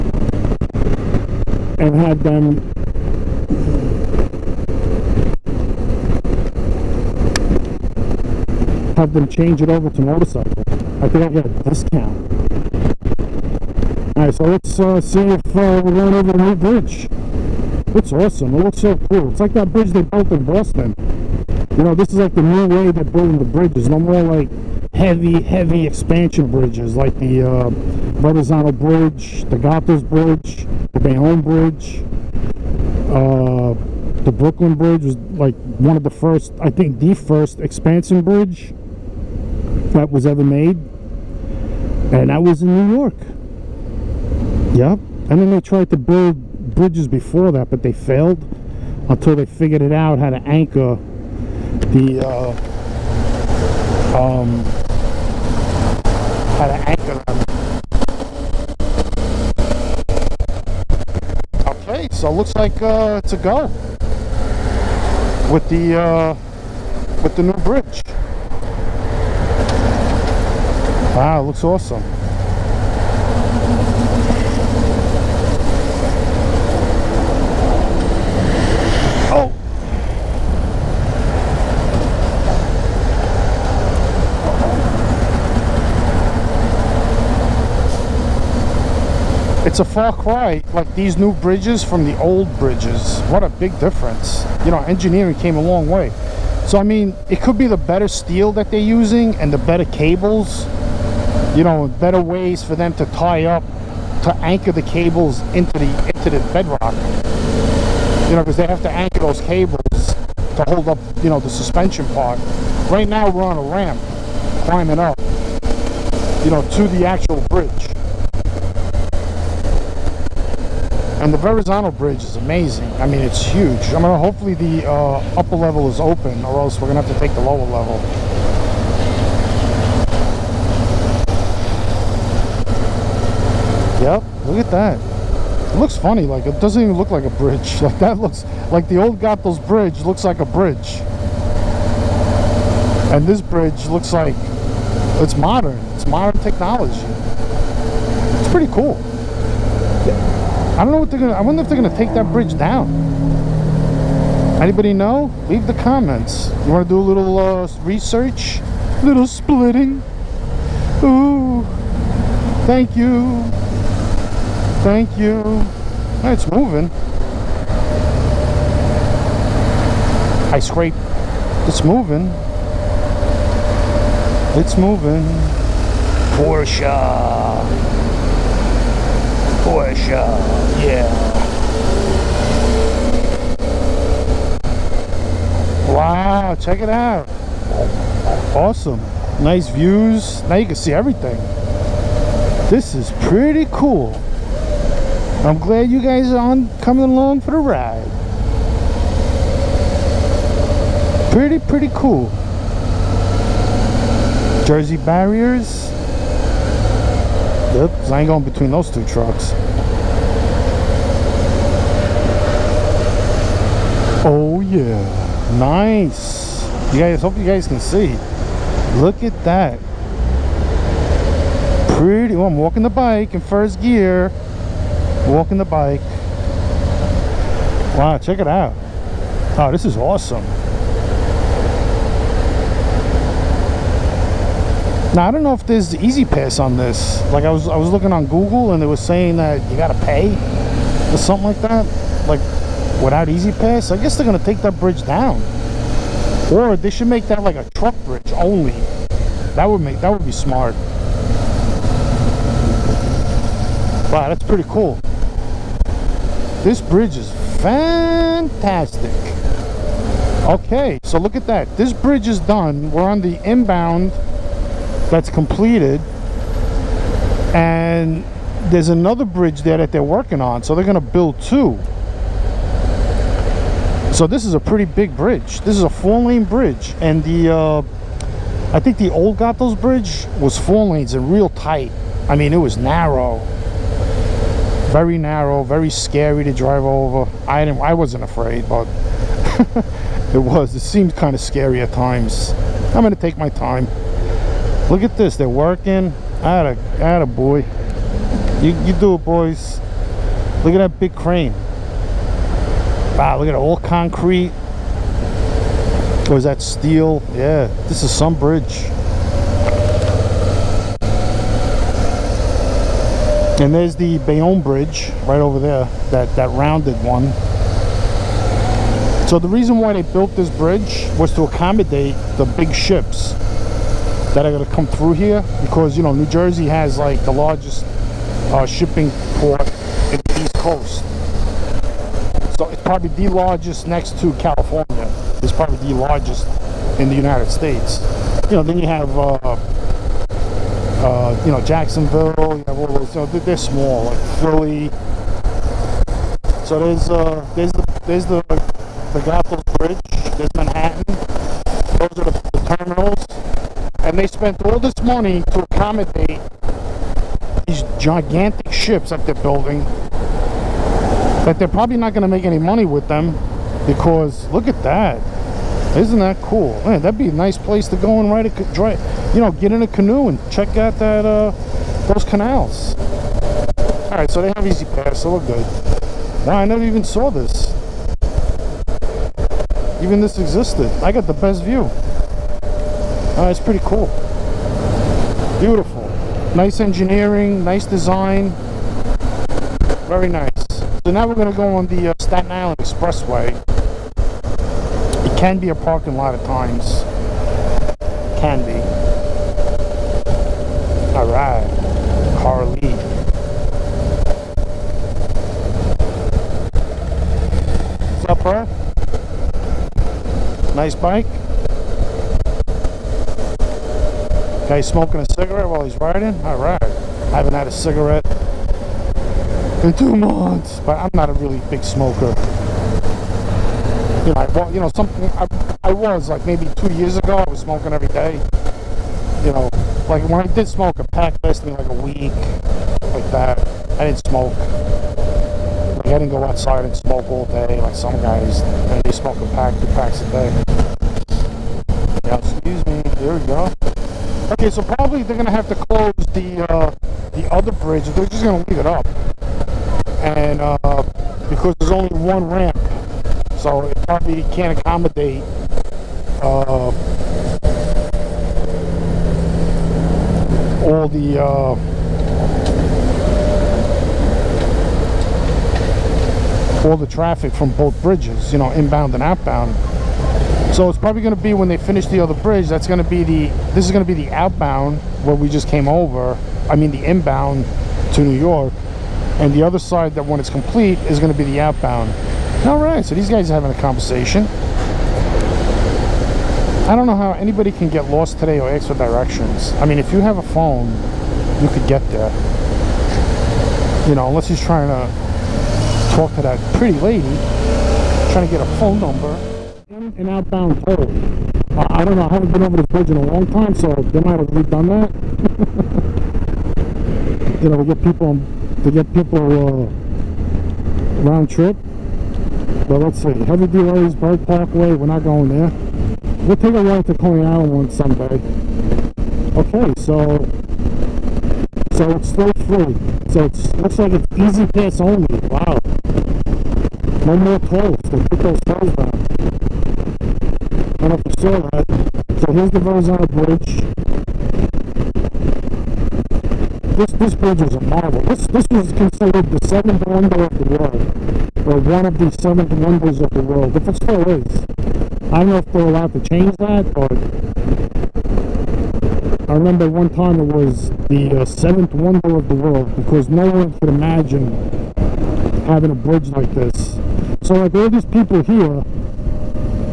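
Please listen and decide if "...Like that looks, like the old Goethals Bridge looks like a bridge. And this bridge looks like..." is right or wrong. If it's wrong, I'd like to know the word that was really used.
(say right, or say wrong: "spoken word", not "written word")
right.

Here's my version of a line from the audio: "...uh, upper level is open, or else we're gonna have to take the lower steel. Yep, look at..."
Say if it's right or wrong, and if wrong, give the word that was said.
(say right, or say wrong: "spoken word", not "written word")
wrong: "level", not "steel".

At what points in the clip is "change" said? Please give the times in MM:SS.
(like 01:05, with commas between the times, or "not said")
00:09, 09:06.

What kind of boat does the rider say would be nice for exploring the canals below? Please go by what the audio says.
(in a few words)
canoe.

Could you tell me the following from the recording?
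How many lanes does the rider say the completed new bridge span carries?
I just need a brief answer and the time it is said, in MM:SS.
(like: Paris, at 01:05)
4, at 04:35.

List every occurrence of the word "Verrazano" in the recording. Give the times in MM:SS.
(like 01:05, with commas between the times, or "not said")
00:27, 02:01, 08:52.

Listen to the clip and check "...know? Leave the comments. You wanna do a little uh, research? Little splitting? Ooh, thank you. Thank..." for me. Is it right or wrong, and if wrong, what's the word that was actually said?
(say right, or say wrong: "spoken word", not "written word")
right.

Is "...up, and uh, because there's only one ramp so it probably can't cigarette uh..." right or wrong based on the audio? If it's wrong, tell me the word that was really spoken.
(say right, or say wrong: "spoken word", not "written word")
wrong: "accommodate", not "cigarette".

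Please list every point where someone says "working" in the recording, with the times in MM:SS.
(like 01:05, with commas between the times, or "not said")
04:30, 04:55.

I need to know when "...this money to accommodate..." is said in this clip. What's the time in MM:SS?
05:54.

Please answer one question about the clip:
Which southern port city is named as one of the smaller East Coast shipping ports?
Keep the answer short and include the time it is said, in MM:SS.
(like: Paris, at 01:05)
Jacksonville, at 05:41.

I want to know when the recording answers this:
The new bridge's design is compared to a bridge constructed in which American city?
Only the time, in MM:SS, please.
00:20.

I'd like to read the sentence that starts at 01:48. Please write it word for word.
You know, because they have to anchor those cables to hold up, you know, the suspension part.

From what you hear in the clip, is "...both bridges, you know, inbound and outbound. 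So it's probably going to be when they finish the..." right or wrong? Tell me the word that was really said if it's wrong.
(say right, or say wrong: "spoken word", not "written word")
right.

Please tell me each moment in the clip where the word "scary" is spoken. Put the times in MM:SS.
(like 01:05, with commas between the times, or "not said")
04:45, 04:51.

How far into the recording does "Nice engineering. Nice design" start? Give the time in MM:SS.
06:26.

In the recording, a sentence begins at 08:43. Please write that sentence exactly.
So it looks like it's easy pass only.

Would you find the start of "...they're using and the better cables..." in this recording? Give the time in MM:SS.
01:38.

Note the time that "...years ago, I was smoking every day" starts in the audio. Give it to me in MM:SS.
07:06.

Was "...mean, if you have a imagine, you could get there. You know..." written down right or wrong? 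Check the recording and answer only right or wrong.
wrong.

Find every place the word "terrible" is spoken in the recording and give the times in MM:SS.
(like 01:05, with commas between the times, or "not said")
not said.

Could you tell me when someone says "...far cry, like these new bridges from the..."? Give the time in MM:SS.
01:29.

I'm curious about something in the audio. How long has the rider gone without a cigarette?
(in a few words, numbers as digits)
2 months.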